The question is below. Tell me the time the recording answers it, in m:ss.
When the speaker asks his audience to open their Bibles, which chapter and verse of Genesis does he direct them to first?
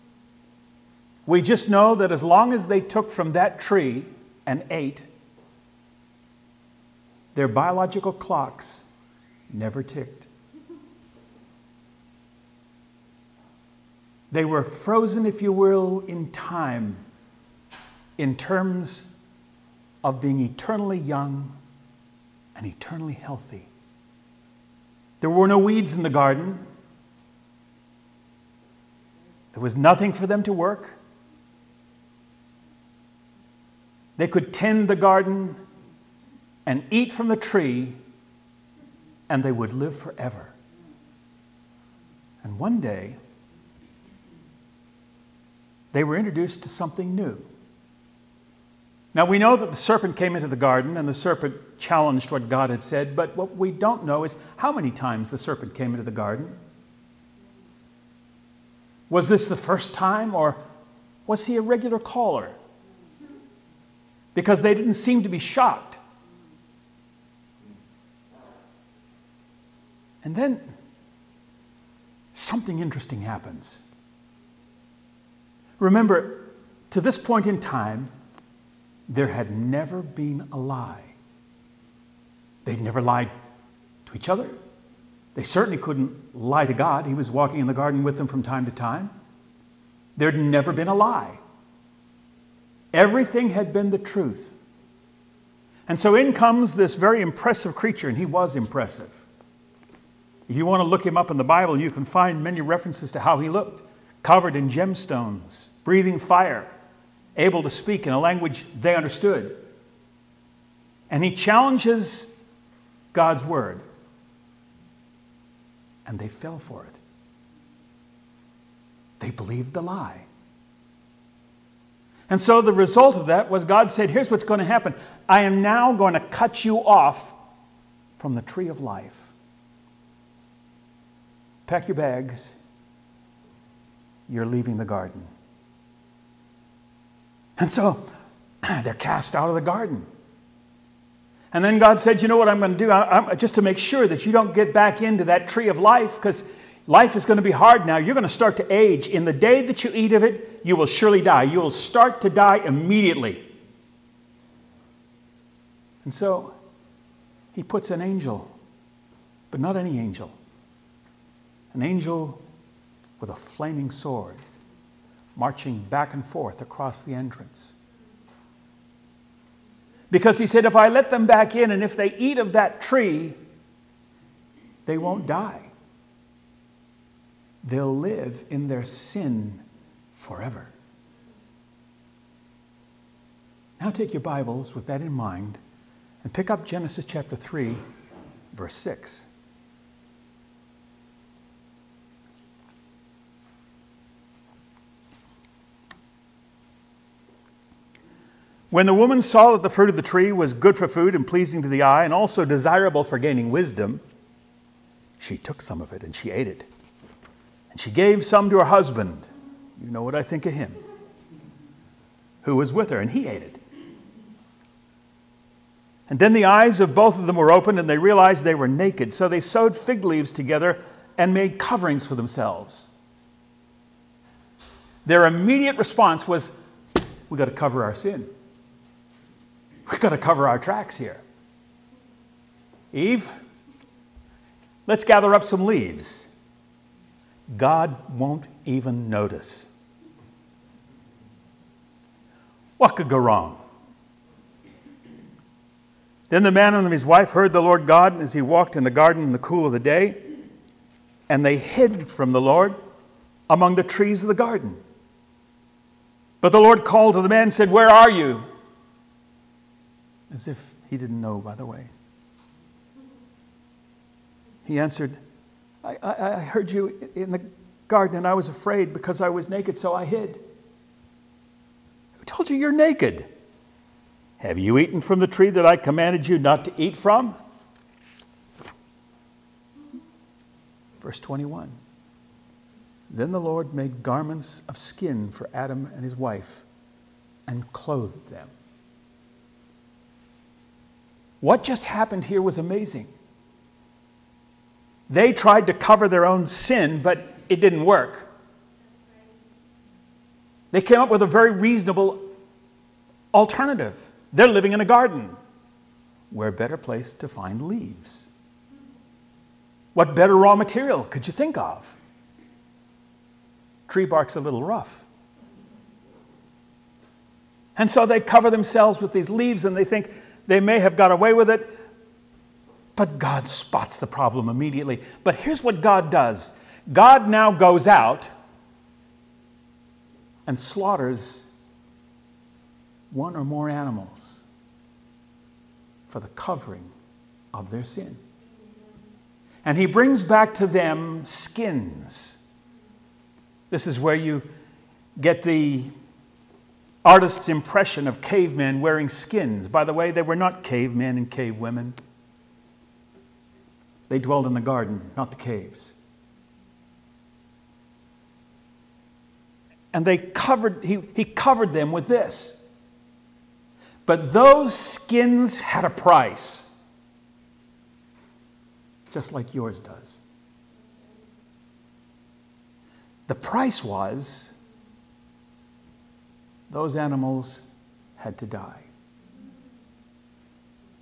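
3:06.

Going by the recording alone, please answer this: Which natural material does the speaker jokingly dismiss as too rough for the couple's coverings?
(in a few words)
Tree bark.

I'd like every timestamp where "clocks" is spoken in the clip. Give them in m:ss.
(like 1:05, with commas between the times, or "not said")
0:08.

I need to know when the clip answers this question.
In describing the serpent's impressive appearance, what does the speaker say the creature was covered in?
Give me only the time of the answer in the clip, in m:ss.
1:44.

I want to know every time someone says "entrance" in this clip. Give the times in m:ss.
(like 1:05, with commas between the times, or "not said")
2:47.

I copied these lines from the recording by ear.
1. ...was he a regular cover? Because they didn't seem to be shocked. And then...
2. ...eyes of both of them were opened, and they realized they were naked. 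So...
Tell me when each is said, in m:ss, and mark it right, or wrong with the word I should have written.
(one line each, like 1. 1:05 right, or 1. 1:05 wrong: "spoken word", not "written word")
1. 1:01 wrong: "caller", not "cover"
2. 3:36 right.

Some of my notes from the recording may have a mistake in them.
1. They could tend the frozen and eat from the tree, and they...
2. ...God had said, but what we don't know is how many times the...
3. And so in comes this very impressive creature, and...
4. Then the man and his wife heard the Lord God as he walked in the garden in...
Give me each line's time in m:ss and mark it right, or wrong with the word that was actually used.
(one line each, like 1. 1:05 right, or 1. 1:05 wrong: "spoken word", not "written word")
1. 0:34 wrong: "garden", not "frozen"
2. 0:52 right
3. 1:35 right
4. 4:06 right.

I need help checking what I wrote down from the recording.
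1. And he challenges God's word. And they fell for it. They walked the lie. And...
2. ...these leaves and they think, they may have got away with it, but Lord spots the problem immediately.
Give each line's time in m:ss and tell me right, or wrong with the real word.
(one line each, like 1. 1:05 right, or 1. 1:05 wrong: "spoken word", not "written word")
1. 1:51 wrong: "believed", not "walked"
2. 5:19 wrong: "God", not "Lord".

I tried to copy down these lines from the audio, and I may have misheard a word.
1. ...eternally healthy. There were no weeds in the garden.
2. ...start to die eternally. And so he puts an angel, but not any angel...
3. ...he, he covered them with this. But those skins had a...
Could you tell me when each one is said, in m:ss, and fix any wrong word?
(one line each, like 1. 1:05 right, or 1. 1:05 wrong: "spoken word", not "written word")
1. 0:22 right
2. 2:31 wrong: "immediately", not "eternally"
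3. 6:00 right.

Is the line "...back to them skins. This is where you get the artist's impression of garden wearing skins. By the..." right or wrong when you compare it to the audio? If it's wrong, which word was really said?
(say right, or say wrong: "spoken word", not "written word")
wrong: "cavemen", not "garden".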